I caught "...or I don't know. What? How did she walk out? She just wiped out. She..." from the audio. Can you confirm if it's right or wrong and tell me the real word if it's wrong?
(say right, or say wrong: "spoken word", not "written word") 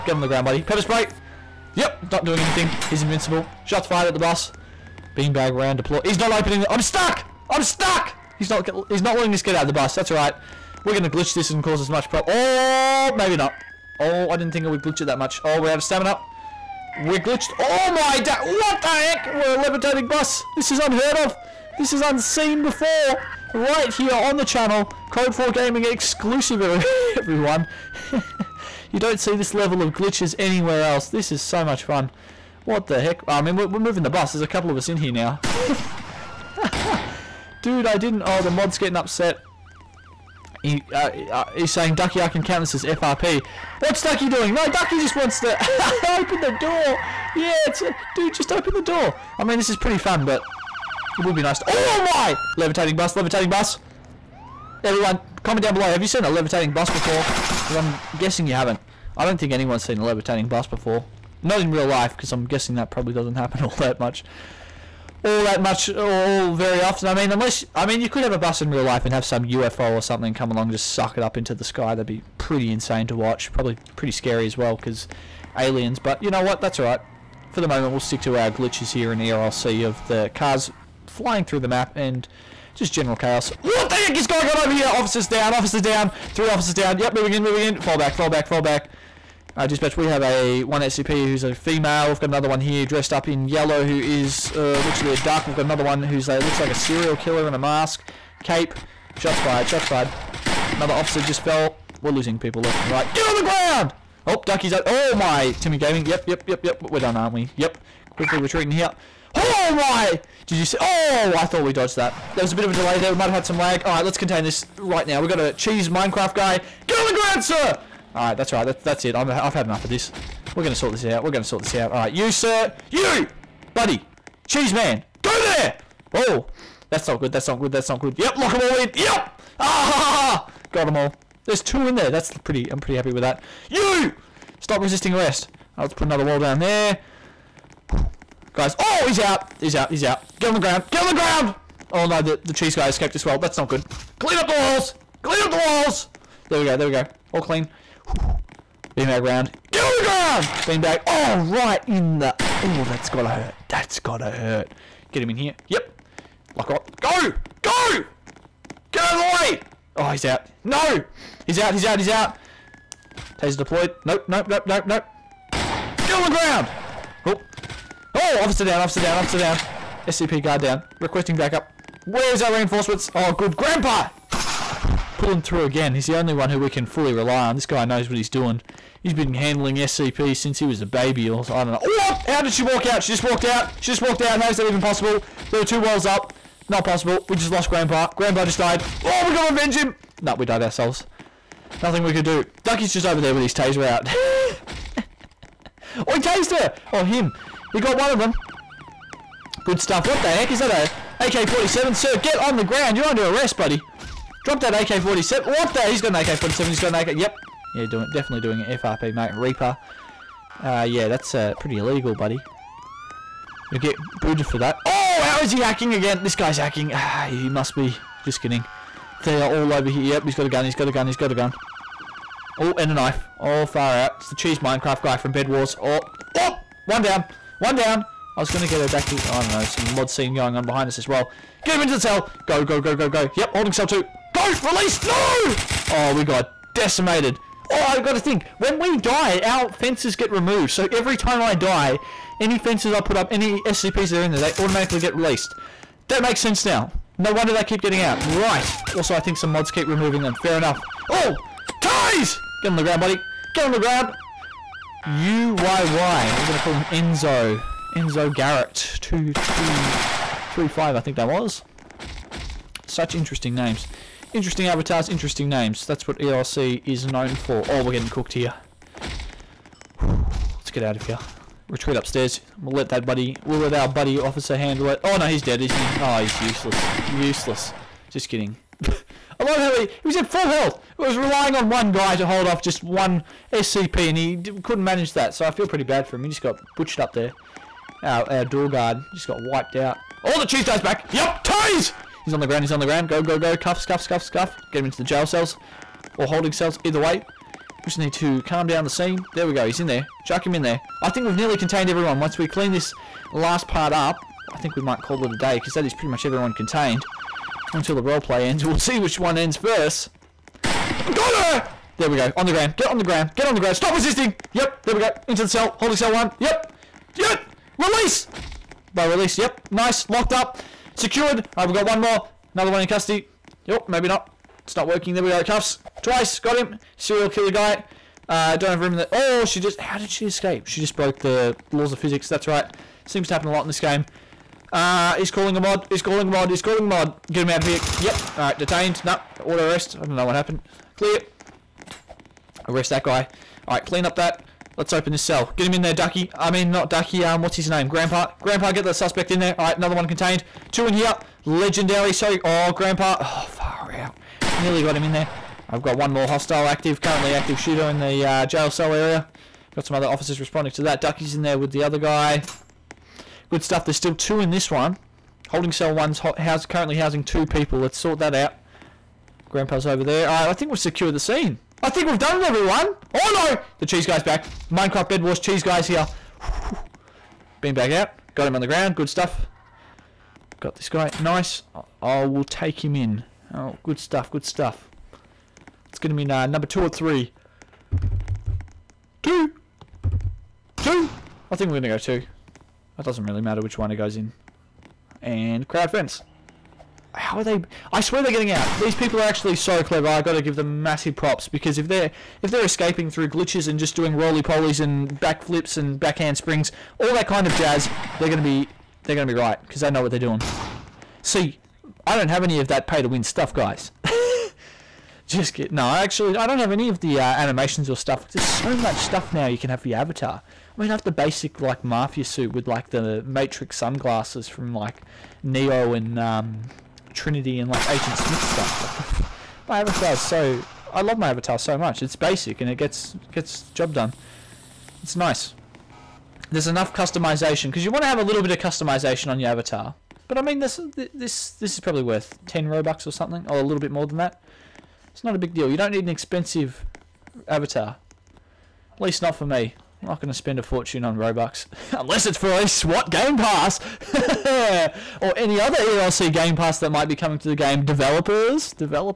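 wrong: "walked", not "wiped".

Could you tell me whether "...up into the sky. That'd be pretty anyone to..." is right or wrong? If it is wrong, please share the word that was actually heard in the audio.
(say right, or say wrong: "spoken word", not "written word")
wrong: "insane", not "anyone".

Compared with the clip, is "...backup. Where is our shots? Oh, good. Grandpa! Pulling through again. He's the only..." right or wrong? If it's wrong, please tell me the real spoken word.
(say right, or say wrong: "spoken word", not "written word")
wrong: "reinforcements", not "shots".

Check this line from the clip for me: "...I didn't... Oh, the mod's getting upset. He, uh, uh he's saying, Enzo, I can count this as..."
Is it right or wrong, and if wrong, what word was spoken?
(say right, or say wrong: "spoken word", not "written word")
wrong: "Ducky", not "Enzo".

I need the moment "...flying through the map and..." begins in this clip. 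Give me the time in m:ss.
1:21.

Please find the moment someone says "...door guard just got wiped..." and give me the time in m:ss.
4:48.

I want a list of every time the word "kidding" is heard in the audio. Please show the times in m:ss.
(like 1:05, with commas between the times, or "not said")
3:38, 4:38, 6:55.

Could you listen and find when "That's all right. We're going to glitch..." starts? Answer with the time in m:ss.
0:09.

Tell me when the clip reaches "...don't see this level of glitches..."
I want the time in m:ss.
0:28.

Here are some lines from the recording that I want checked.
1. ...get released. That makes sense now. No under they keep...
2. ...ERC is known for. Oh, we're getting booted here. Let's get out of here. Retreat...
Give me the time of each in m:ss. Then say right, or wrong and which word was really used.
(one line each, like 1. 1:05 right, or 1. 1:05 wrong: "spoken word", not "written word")
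1. 4:04 wrong: "wonder", not "under"
2. 4:26 wrong: "cooked", not "booted".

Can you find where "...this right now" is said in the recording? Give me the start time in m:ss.
1:54.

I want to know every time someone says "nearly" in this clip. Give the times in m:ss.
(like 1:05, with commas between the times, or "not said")
5:01, 5:54.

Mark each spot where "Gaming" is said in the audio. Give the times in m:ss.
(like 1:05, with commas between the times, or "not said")
0:25, 1:45.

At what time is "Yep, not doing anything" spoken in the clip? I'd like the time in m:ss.
0:01.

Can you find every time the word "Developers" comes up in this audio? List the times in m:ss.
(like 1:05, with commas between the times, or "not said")
7:37.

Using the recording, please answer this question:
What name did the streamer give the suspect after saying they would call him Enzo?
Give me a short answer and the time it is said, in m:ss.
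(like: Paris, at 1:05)
Enzo Garrett, at 4:17.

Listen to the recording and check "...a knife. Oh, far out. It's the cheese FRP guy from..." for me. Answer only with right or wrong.
wrong.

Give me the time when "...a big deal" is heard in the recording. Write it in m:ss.
7:25.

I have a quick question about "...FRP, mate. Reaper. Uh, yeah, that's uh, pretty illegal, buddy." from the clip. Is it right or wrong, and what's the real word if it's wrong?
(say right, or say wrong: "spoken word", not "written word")
right.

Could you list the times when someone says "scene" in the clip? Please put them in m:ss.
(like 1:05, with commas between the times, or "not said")
3:50, 4:58, 6:11.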